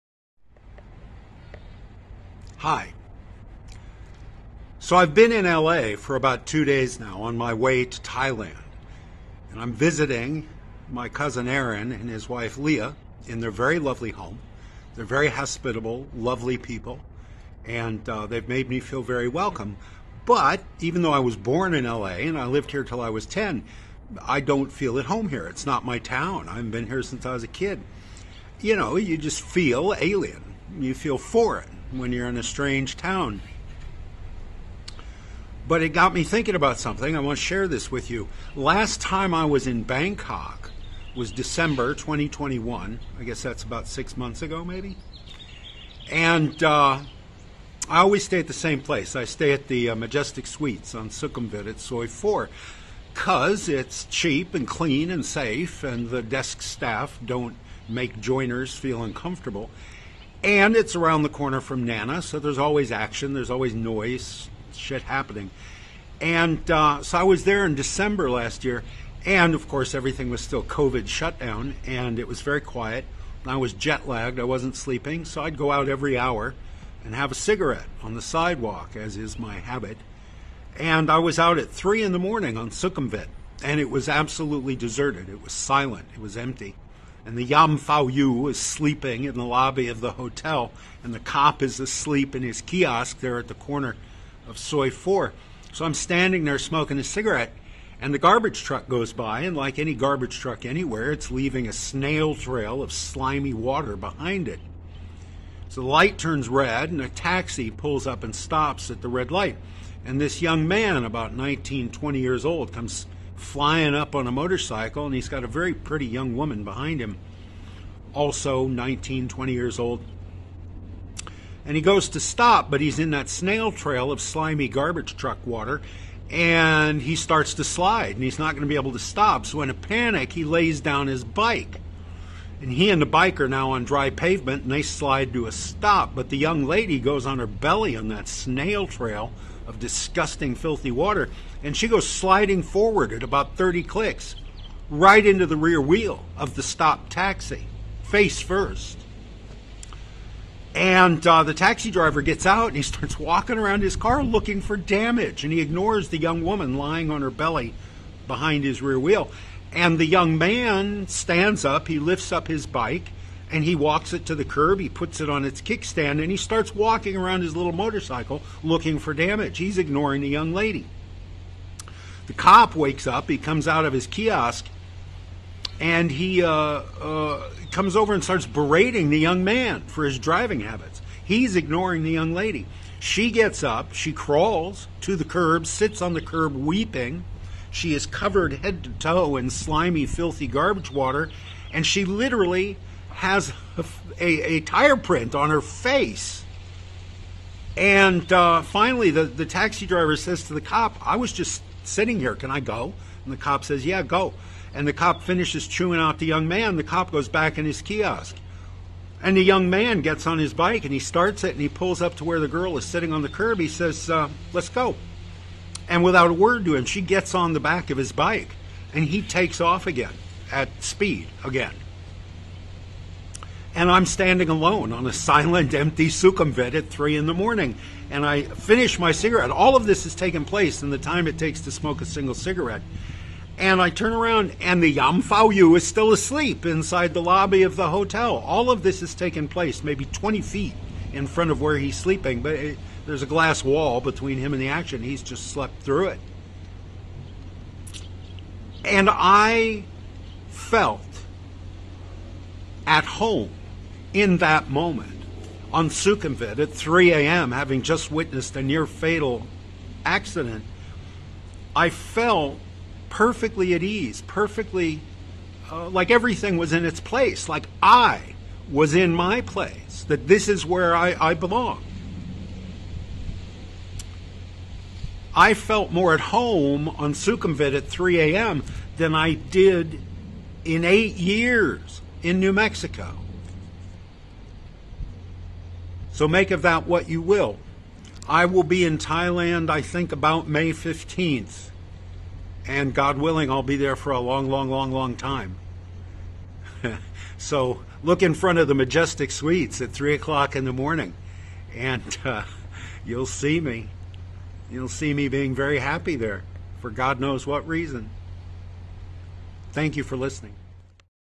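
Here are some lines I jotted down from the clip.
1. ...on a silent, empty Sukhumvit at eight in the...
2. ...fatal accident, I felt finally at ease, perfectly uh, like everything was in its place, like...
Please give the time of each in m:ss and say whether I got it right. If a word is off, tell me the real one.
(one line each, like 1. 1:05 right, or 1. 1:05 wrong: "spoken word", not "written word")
1. 3:44 wrong: "three", not "eight"
2. 4:18 wrong: "perfectly", not "finally".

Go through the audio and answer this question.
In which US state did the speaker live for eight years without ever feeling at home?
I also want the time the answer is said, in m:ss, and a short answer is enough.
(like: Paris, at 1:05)
New Mexico, at 4:42.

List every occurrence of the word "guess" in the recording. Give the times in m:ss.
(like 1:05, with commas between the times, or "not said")
0:43.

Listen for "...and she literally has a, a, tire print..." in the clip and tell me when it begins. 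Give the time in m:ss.
3:11.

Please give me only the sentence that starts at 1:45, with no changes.
So the light turns red, and a taxi pulls up and stops at the red light.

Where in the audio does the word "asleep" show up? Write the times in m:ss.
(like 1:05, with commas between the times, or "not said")
1:31, 3:56.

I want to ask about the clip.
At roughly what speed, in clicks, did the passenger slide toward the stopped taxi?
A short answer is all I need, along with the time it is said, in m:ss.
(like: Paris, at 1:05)
30, at 2:23.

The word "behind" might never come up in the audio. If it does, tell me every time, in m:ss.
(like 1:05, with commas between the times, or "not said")
1:43, 1:56, 2:38.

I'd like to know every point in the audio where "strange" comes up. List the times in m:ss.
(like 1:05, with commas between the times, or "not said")
0:32.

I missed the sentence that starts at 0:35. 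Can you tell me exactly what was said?
But it got me thinking about something.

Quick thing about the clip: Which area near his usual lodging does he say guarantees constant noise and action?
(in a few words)
Nana.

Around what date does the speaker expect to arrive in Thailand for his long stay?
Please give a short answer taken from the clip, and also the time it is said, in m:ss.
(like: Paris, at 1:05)
May 15th, at 4:50.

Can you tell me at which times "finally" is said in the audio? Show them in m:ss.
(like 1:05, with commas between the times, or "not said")
3:18.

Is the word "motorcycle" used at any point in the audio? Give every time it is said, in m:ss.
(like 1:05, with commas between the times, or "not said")
1:54, 2:47.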